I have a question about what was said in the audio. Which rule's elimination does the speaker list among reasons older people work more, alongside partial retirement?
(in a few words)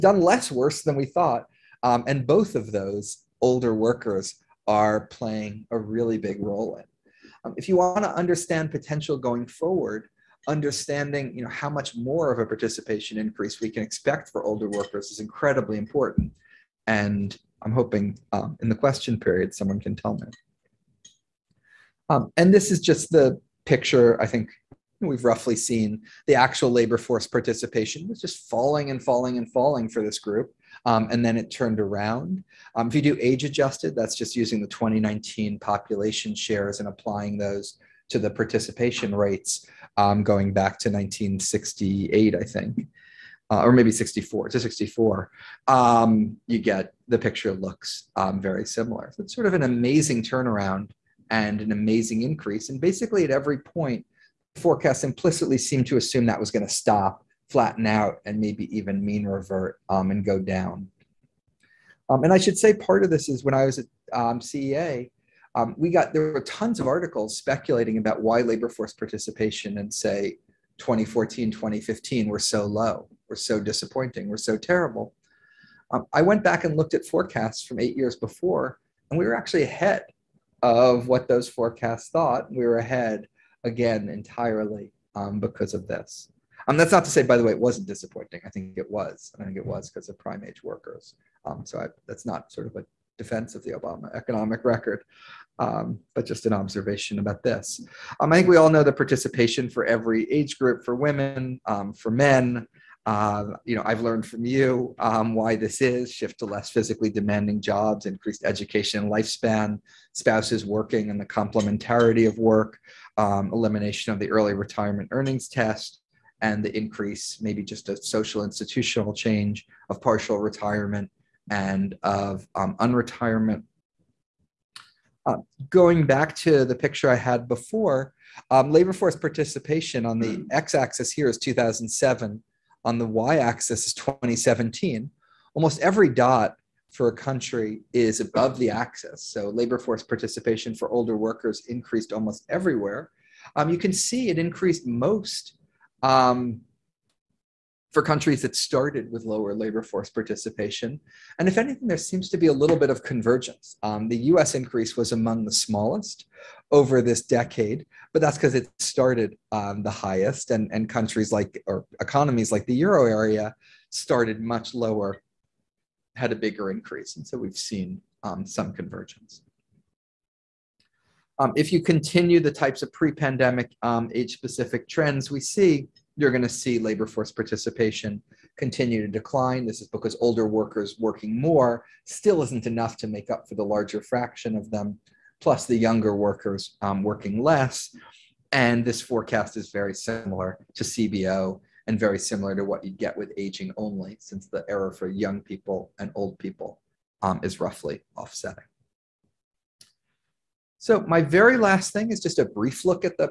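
early retirement earnings test.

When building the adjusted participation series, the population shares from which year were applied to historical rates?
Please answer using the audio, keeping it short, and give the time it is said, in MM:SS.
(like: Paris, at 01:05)
2019, at 00:34.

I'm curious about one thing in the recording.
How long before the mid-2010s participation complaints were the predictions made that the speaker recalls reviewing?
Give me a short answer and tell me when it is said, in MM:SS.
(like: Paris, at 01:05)
eight years, at 01:17.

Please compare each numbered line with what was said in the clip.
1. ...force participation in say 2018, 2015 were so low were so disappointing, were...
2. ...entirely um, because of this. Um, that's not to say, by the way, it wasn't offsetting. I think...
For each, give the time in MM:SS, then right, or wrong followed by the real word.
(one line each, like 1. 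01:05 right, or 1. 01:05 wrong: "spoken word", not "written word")
1. 01:08 wrong: "2014", not "2018"
2. 01:24 wrong: "disappointing", not "offsetting".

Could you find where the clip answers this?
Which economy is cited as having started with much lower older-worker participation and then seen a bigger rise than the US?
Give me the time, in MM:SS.
02:42.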